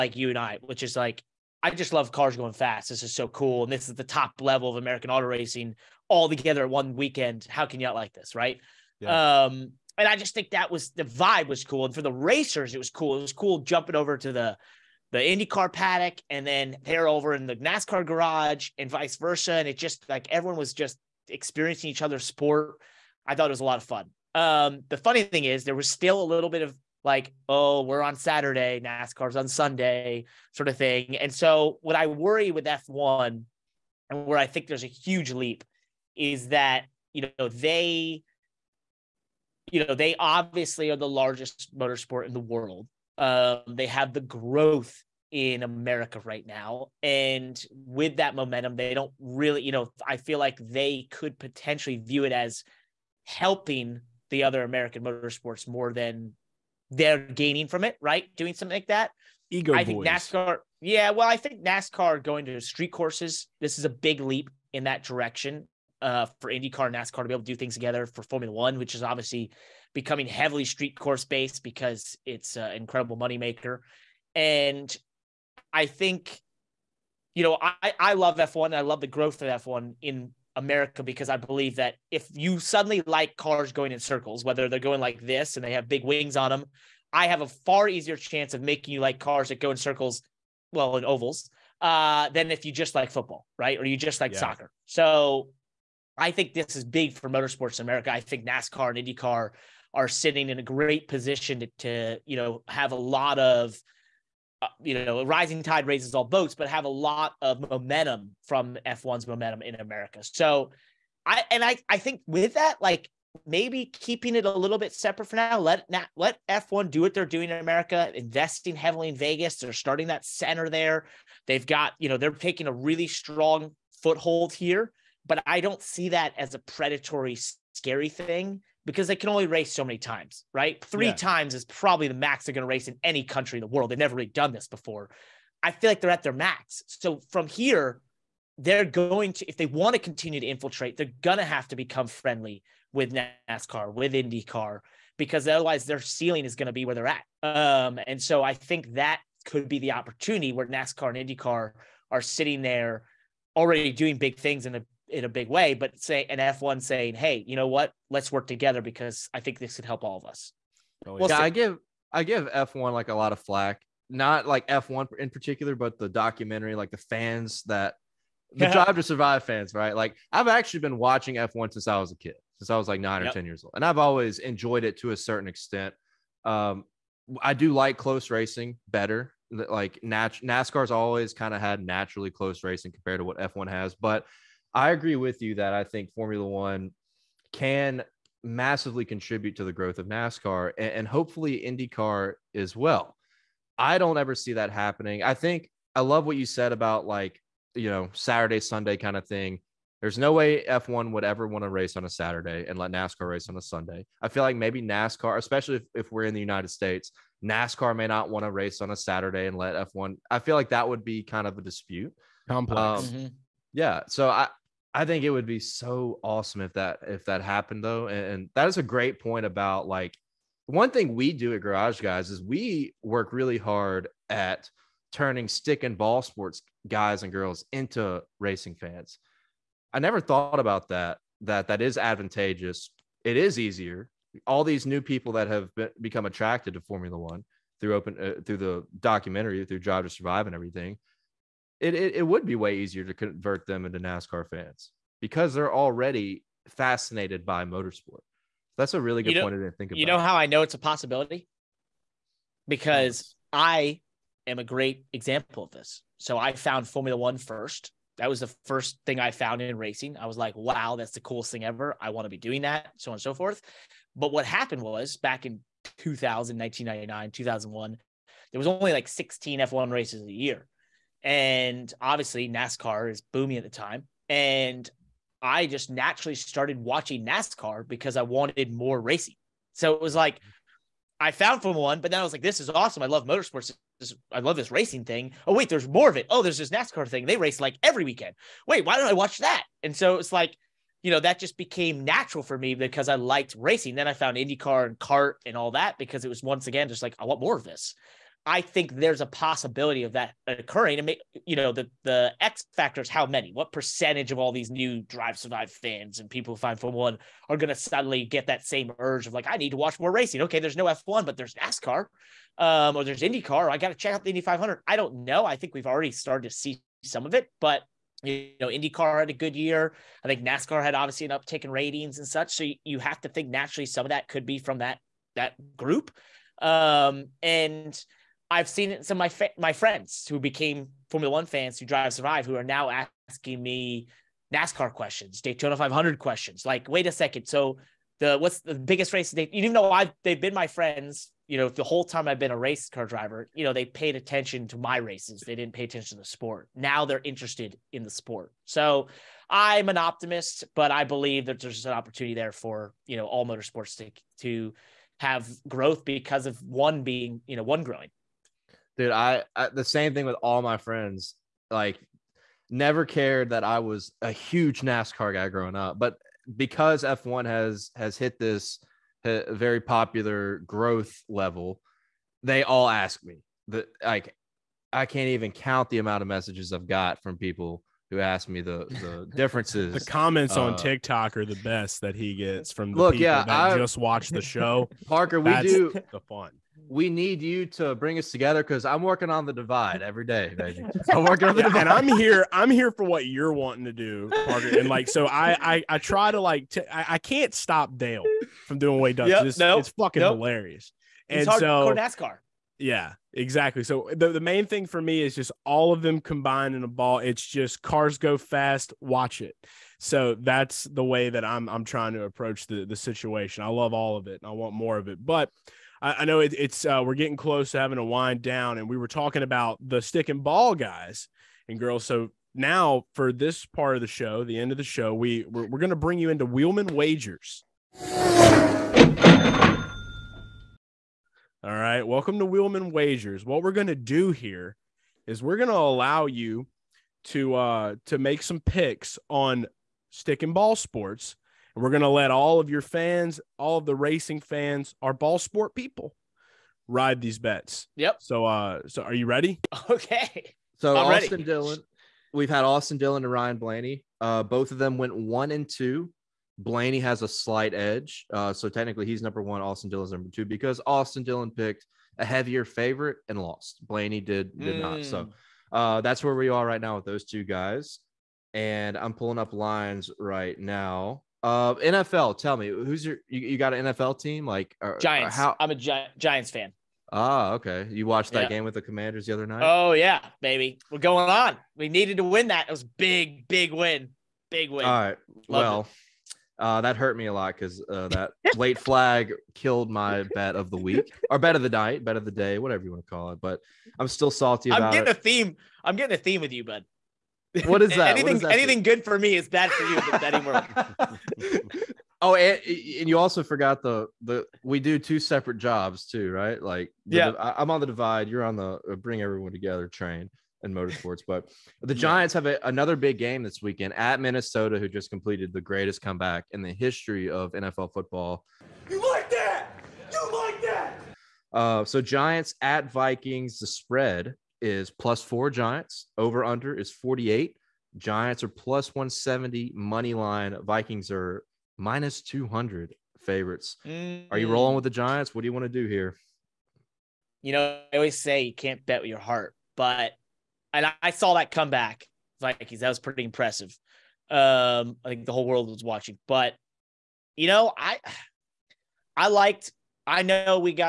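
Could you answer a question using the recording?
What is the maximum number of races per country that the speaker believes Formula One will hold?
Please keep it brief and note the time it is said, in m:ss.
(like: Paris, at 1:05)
3, at 2:10.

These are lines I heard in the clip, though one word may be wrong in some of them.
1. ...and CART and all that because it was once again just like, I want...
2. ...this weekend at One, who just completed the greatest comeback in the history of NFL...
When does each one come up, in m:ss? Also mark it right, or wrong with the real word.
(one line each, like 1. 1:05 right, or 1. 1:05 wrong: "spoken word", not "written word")
1. 4:54 right
2. 8:33 wrong: "Minnesota", not "One".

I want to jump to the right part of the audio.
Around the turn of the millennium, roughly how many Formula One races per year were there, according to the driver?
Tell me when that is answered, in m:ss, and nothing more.
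4:29.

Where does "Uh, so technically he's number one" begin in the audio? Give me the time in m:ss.
7:38.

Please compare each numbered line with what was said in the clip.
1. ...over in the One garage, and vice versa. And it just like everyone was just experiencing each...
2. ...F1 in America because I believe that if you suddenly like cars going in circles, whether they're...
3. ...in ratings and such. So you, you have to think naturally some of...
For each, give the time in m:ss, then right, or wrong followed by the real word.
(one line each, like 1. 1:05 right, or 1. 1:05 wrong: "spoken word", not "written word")
1. 0:17 wrong: "NASCAR", not "One"
2. 1:19 right
3. 5:21 right.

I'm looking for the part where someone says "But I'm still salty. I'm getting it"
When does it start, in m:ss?
8:13.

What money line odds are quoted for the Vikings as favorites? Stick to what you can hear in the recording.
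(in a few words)
-200.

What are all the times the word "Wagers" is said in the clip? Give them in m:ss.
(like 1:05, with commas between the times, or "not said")
7:06, 7:12.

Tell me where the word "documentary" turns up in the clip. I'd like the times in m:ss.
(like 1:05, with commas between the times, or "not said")
2:46, 3:59.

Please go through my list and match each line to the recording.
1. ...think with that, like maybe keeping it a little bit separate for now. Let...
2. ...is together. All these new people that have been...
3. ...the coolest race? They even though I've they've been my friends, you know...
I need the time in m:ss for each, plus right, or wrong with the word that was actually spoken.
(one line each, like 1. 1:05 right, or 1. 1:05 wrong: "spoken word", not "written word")
1. 1:51 right
2. 3:53 wrong: "easier", not "together"
3. 5:38 wrong: "biggest", not "coolest".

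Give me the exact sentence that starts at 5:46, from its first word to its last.
Now they're interested in the sport.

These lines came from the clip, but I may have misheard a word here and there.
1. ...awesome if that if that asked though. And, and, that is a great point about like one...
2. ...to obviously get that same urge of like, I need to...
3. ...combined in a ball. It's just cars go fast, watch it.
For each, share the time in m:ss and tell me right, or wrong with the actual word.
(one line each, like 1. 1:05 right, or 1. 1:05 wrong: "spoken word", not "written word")
1. 3:36 wrong: "happened", not "asked"
2. 5:07 wrong: "suddenly", not "obviously"
3. 6:46 right.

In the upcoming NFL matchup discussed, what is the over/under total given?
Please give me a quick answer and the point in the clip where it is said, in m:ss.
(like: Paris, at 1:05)
48, at 8:46.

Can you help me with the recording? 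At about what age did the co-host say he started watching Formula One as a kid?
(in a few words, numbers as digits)
9.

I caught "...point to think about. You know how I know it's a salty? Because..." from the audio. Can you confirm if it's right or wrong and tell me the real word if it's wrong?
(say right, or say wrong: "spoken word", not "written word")
wrong: "possibility", not "salty".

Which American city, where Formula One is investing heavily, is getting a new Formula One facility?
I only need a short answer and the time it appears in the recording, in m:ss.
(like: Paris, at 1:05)
Vegas, at 1:59.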